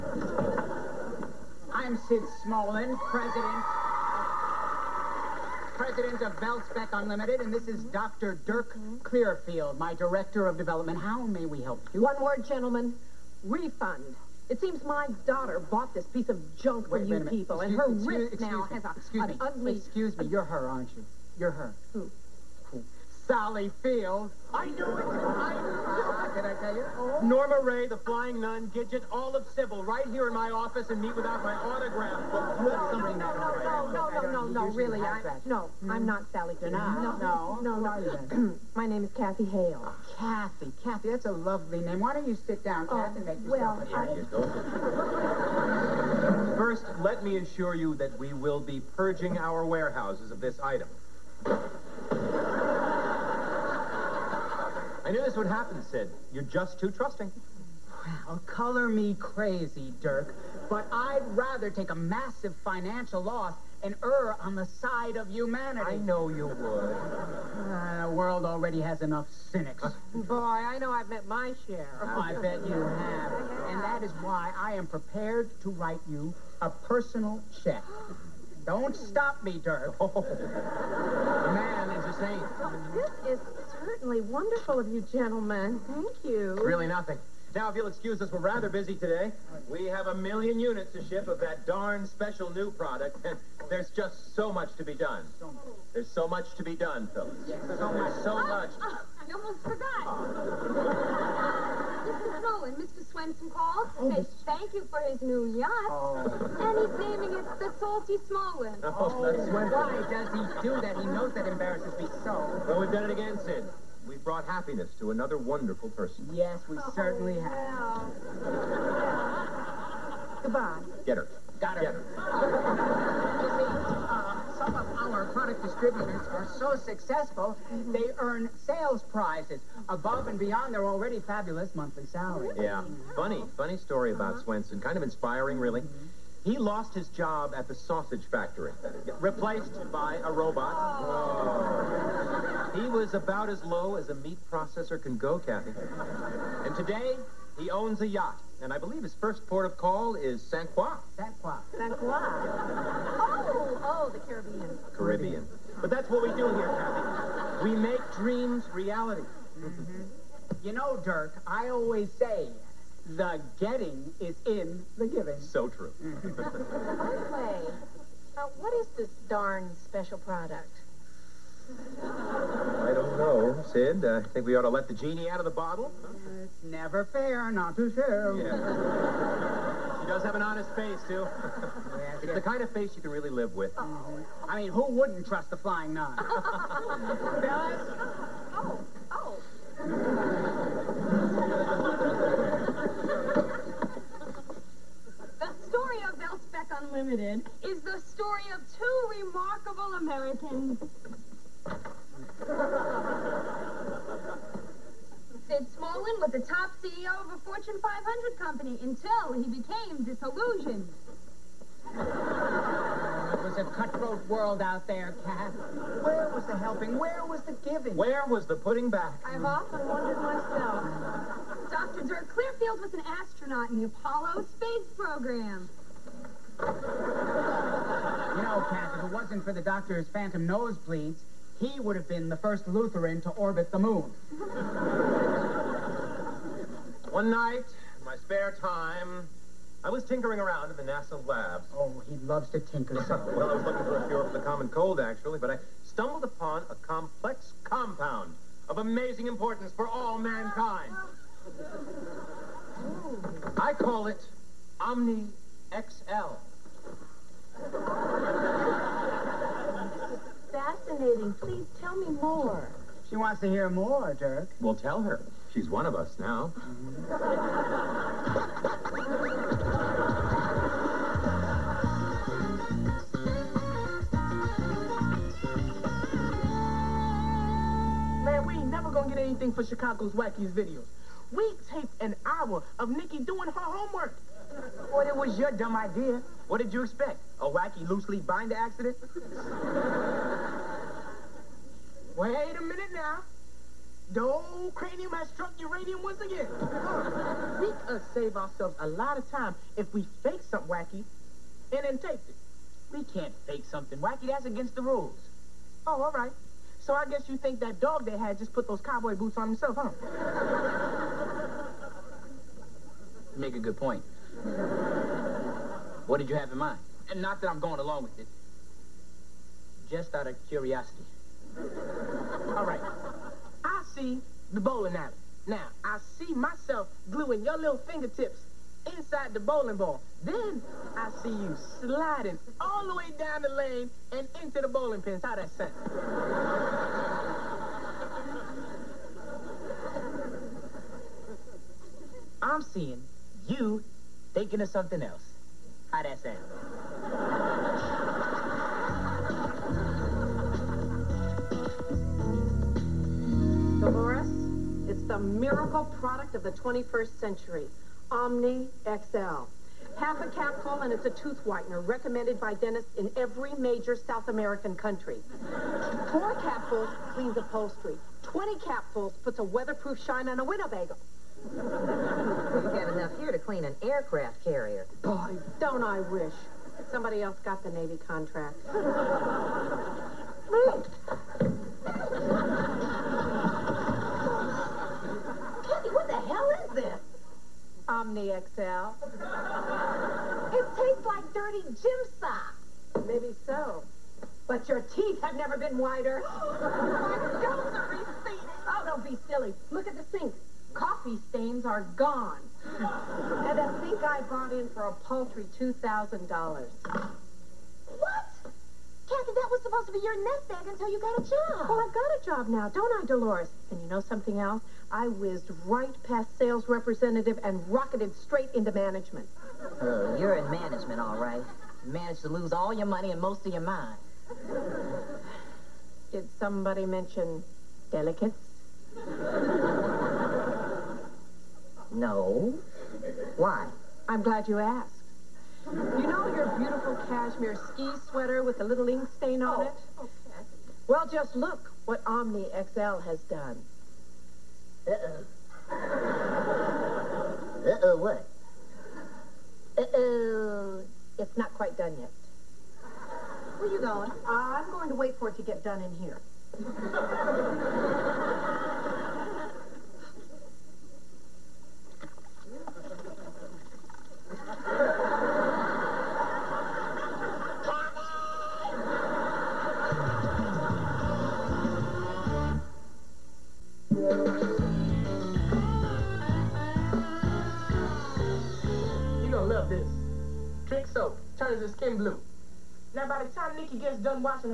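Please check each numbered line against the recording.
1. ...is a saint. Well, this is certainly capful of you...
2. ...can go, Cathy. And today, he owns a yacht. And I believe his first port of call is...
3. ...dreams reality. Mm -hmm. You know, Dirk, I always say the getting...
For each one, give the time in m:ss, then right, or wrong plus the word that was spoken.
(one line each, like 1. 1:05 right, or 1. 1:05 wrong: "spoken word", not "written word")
1. 1:21 wrong: "wonderful", not "capful"
2. 2:25 right
3. 2:38 right.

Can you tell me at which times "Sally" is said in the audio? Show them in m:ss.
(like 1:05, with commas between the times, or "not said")
0:23, 0:36.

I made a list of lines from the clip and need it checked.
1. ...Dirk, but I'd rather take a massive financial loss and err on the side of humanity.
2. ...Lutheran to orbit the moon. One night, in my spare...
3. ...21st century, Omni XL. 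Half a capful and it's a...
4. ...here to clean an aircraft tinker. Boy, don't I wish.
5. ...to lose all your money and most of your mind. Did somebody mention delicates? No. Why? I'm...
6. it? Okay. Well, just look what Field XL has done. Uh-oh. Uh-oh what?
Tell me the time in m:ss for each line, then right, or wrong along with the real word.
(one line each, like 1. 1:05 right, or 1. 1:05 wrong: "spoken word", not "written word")
1. 1:00 right
2. 3:52 right
3. 5:56 right
4. 6:13 wrong: "carrier", not "tinker"
5. 7:02 right
6. 7:19 wrong: "Omni", not "Field".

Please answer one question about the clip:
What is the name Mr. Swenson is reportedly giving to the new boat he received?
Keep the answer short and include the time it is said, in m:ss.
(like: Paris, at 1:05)
the Salty Smallwood, at 1:47.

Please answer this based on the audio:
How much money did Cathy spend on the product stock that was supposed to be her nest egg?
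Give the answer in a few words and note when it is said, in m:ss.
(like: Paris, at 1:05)
$2,000, at 6:45.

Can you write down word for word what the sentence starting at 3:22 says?
Sid Smolin was the top CEO of a Fortune 500 company until he became disillusioned.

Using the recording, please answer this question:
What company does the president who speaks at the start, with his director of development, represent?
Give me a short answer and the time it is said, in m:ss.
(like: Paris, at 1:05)
Velspec Unlimited, at 0:06.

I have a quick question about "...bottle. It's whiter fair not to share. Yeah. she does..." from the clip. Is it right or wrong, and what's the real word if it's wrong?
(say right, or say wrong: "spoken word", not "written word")
wrong: "never", not "whiter".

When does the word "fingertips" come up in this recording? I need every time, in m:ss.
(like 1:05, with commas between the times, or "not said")
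5:27.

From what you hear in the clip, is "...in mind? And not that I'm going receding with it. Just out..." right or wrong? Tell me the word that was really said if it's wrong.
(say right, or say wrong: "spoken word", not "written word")
wrong: "along", not "receding".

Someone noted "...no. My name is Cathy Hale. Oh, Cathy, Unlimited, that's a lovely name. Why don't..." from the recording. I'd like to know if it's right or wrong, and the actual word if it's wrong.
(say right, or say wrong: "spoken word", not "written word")
wrong: "Cathy", not "Unlimited".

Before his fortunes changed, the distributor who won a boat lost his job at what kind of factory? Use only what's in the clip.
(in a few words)
sausage factory.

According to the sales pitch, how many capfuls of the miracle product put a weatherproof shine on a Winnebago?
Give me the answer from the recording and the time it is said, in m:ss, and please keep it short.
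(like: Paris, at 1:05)
20, at 6:08.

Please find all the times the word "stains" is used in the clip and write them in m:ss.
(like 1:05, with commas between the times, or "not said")
6:41, 7:19.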